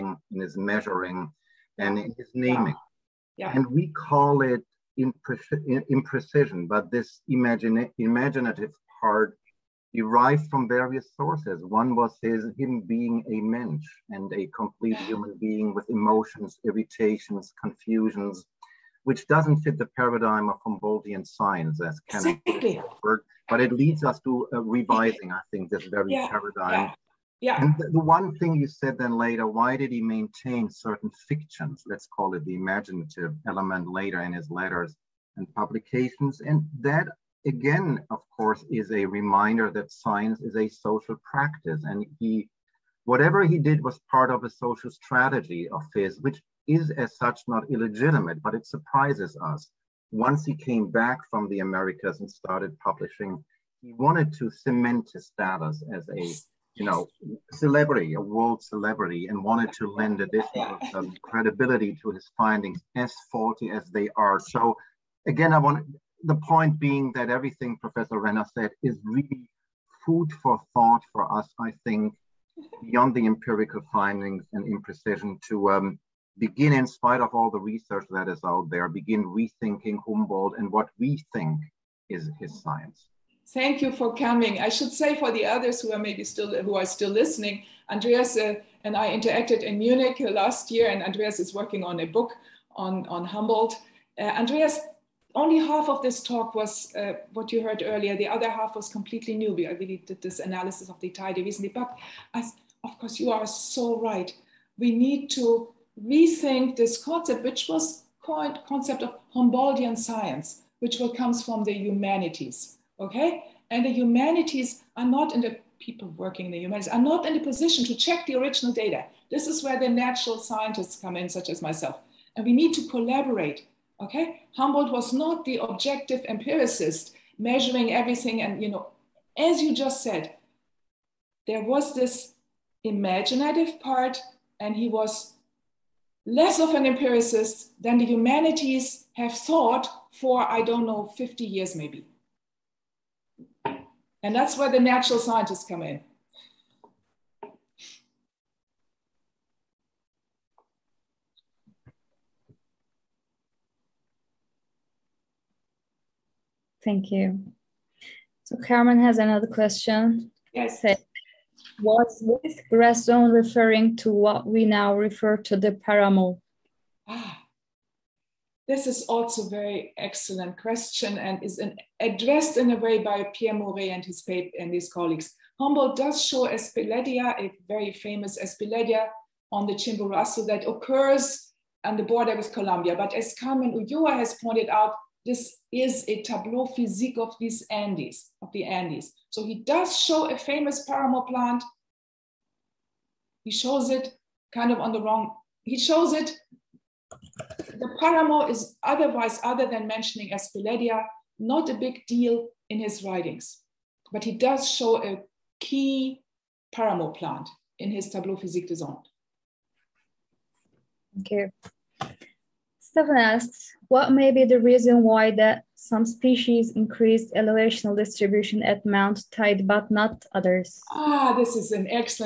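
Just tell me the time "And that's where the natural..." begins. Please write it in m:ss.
2:24.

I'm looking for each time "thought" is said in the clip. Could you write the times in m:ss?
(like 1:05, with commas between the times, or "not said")
1:10, 2:19.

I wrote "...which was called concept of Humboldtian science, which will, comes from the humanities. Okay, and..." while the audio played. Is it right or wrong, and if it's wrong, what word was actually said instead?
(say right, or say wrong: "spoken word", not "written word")
right.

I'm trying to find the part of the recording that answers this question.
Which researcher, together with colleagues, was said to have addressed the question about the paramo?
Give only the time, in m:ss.
2:53.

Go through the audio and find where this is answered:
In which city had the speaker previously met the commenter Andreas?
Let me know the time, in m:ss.
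1:29.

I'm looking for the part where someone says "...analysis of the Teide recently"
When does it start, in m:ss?
1:40.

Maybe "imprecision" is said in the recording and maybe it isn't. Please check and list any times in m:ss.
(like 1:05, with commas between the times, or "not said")
0:04, 1:14.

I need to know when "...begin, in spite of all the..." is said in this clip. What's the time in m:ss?
1:16.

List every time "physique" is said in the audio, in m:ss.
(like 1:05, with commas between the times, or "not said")
3:06, 3:28.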